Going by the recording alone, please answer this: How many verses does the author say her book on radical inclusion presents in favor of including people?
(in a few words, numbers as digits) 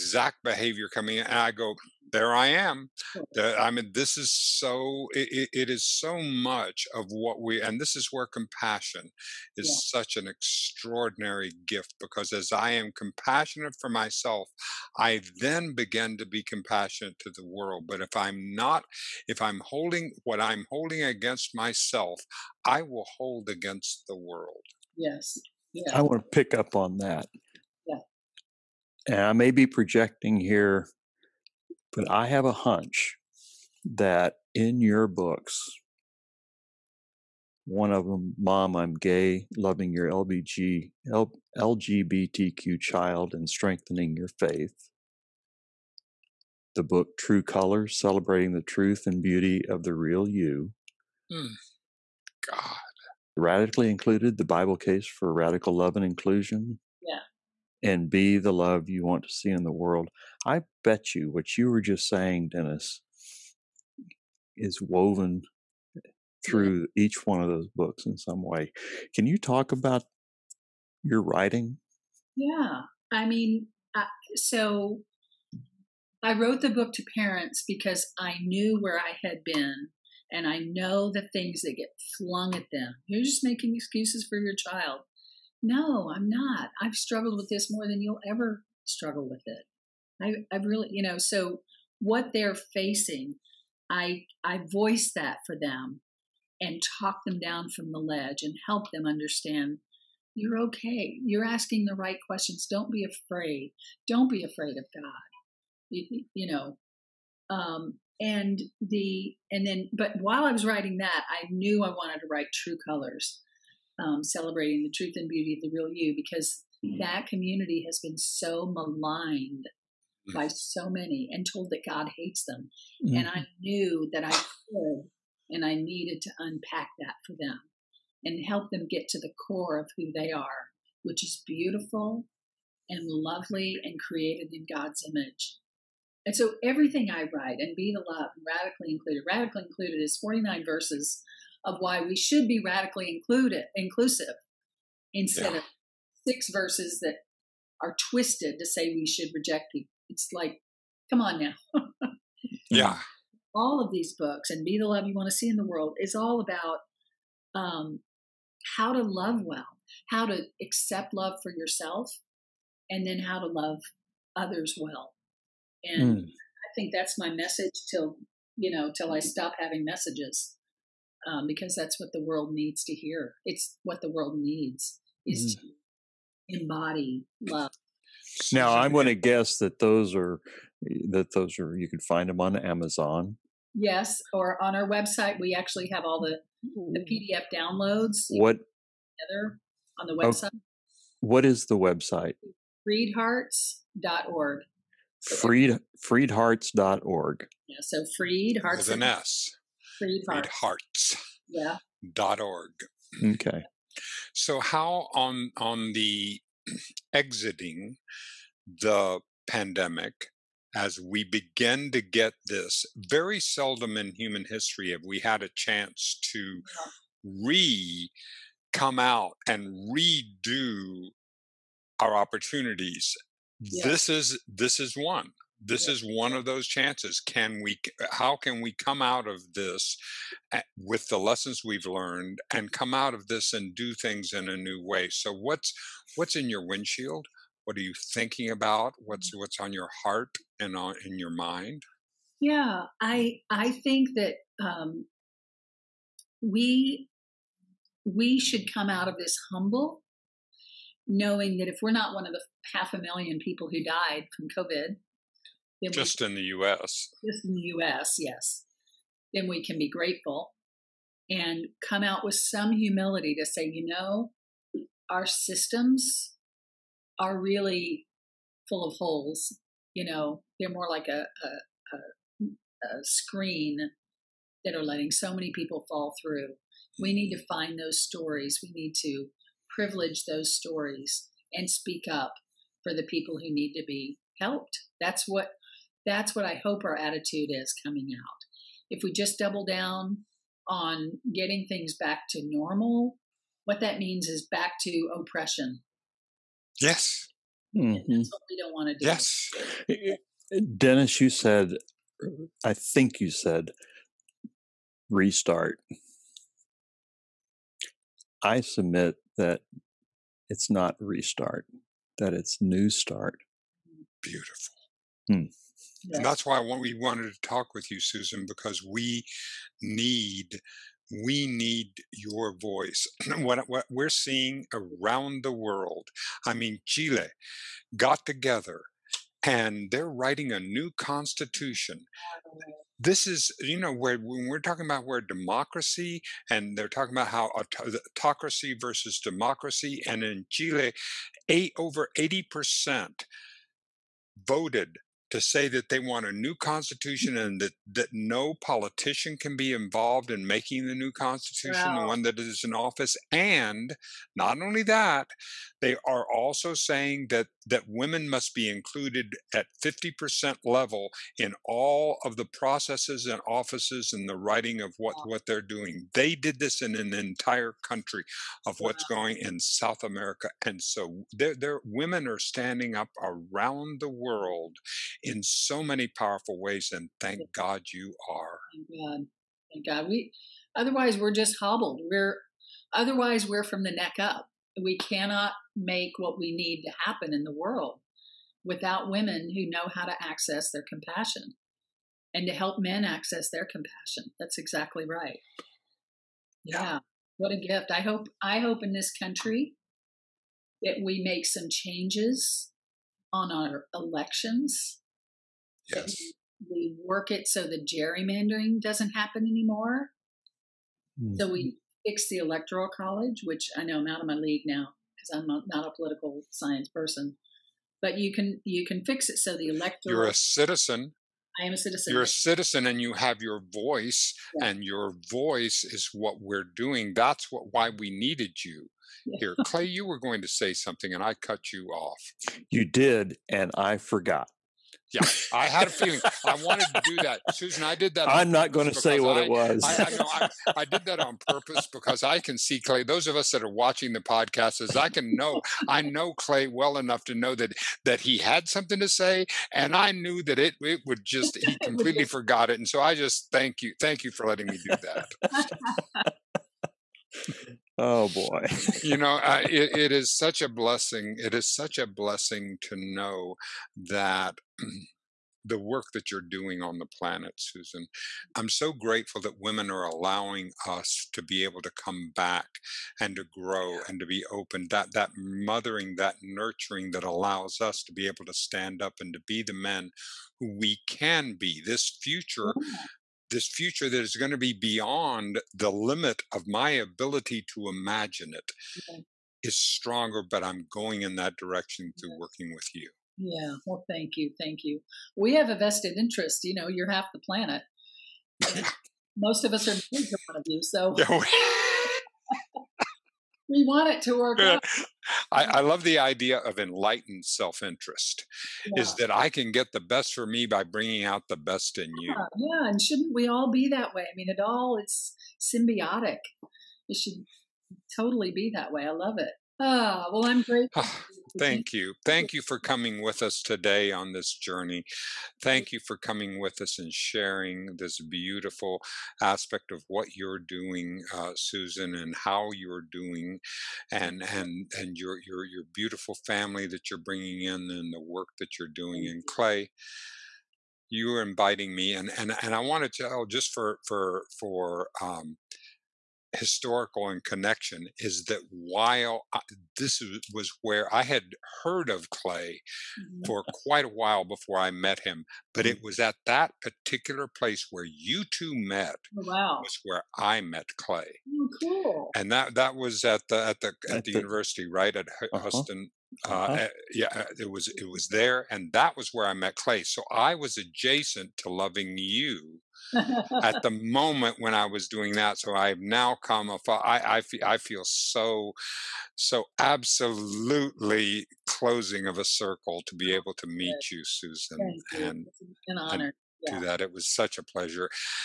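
49.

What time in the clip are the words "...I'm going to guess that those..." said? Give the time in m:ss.
2:58.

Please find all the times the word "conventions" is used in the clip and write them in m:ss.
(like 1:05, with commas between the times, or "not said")
not said.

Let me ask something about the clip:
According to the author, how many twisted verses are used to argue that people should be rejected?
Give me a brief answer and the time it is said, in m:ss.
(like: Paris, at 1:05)
6, at 2:26.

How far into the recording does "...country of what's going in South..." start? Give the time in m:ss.
6:07.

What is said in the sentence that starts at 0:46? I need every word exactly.
The book True Color, Celebrating the Truth and Beauty of the Real You.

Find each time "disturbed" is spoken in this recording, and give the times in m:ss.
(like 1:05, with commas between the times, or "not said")
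not said.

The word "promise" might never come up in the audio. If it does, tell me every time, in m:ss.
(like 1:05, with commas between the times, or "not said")
not said.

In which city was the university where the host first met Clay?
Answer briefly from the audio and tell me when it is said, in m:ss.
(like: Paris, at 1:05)
Houston, at 9:25.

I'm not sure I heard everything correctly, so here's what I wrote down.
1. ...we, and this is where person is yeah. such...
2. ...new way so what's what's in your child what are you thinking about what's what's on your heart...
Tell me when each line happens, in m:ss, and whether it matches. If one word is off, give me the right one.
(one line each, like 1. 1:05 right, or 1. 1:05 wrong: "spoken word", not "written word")
1. 0:07 wrong: "compassion", not "person"
2. 3:54 wrong: "windshield", not "child".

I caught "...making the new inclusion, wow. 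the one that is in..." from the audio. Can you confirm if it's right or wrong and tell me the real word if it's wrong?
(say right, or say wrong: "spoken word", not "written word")
wrong: "constitution", not "inclusion".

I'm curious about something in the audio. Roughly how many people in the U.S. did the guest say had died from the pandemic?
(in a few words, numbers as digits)
half a million.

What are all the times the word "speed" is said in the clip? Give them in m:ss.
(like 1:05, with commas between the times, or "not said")
not said.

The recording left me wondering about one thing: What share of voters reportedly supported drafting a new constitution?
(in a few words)
over 80%.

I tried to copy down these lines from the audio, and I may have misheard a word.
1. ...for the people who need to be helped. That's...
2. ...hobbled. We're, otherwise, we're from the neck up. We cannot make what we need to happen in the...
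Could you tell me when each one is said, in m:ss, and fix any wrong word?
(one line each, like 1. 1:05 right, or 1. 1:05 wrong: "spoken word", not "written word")
1. 4:42 right
2. 6:21 right.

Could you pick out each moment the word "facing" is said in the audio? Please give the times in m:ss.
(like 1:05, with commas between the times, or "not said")
1:32.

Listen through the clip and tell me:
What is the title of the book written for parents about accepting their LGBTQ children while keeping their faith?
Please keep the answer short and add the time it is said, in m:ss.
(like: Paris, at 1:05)
Mom, I'm Gay, at 0:38.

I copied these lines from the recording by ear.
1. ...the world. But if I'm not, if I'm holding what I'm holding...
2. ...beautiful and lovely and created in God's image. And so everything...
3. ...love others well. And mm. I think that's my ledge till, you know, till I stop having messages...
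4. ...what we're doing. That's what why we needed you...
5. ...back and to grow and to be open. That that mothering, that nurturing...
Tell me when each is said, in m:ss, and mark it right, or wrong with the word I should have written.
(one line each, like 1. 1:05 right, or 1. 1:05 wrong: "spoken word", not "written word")
1. 0:17 right
2. 2:11 right
3. 2:43 wrong: "message", not "ledge"
4. 7:06 right
5. 7:52 right.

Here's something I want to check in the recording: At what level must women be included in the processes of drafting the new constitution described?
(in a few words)
50%.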